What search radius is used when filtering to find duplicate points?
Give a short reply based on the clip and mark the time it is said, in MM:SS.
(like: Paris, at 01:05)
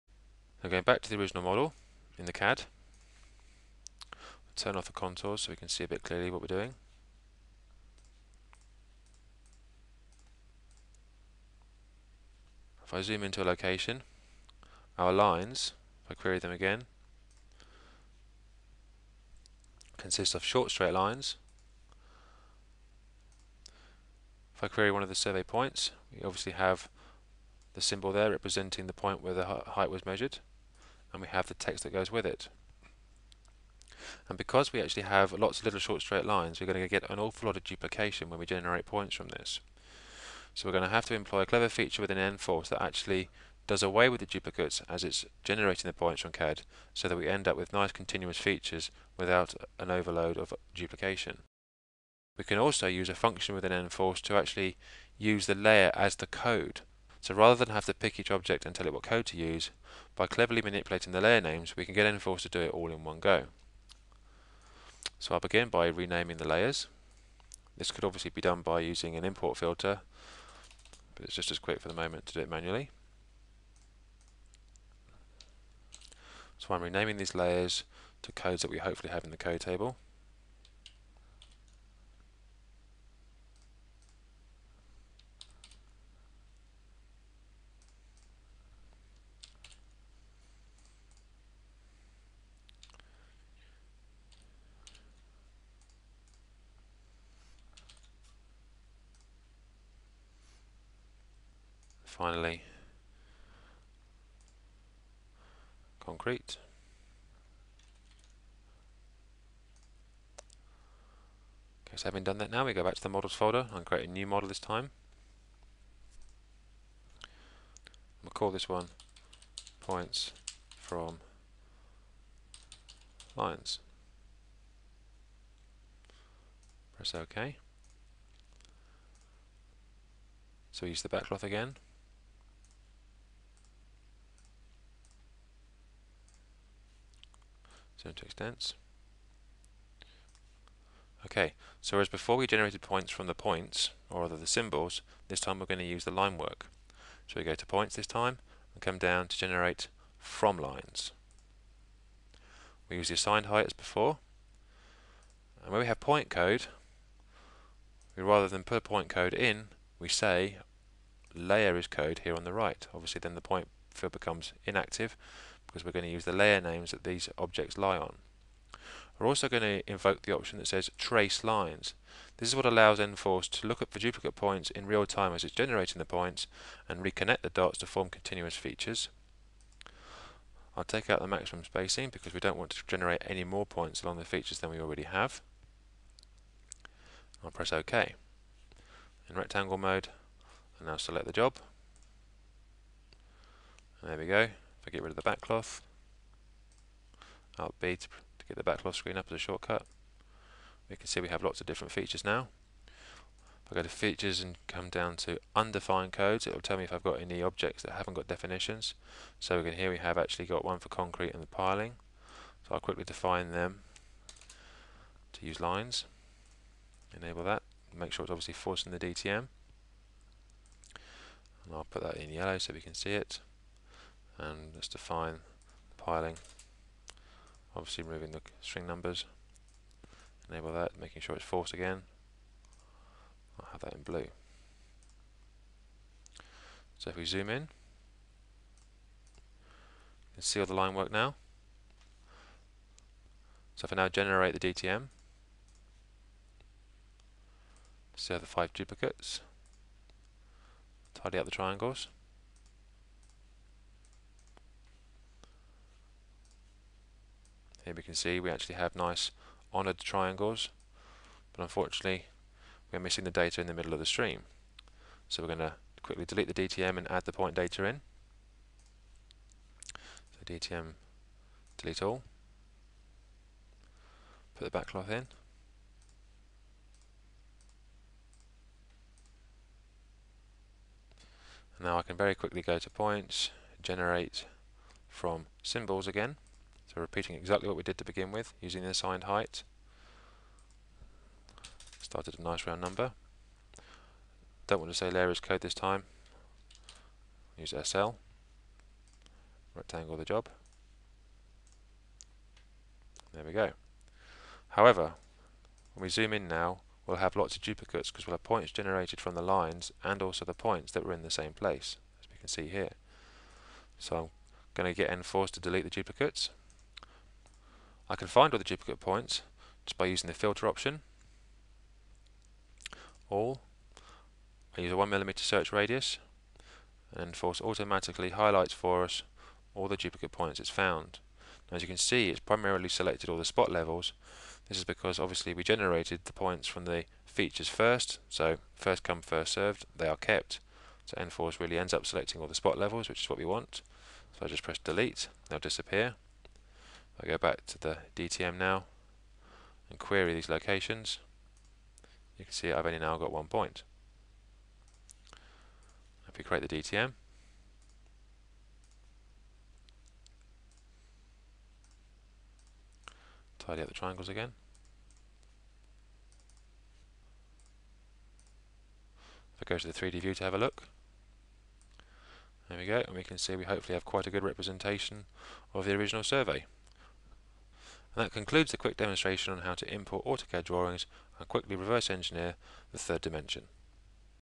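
1mm, at 05:24.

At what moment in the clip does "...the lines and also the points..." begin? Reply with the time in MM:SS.
05:09.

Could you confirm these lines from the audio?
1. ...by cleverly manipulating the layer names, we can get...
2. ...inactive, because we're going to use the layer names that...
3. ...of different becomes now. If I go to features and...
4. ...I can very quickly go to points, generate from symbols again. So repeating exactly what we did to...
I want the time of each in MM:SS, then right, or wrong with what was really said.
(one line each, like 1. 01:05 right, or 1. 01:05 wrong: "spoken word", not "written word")
1. 01:00 right
2. 02:44 right
3. 03:21 wrong: "features", not "becomes"
4. 04:41 right.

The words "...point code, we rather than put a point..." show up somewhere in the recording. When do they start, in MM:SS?
02:35.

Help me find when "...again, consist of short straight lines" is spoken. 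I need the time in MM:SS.
00:16.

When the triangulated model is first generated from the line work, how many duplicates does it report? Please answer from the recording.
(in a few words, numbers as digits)
5.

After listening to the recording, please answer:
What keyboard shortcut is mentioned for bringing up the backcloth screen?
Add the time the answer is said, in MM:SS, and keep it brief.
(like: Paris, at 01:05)
Alt B, at 03:17.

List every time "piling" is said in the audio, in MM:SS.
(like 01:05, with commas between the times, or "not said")
03:31, 03:46.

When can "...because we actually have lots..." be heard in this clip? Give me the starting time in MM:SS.
00:34.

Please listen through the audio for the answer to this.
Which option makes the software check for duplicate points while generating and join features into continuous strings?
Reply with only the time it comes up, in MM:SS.
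02:50.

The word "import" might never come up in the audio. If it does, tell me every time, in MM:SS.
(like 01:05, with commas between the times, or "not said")
01:09, 06:19.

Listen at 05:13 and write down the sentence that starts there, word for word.
So I'm going to get enforced to delete the duplicates.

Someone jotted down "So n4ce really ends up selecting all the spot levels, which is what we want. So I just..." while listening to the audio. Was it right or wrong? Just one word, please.
right.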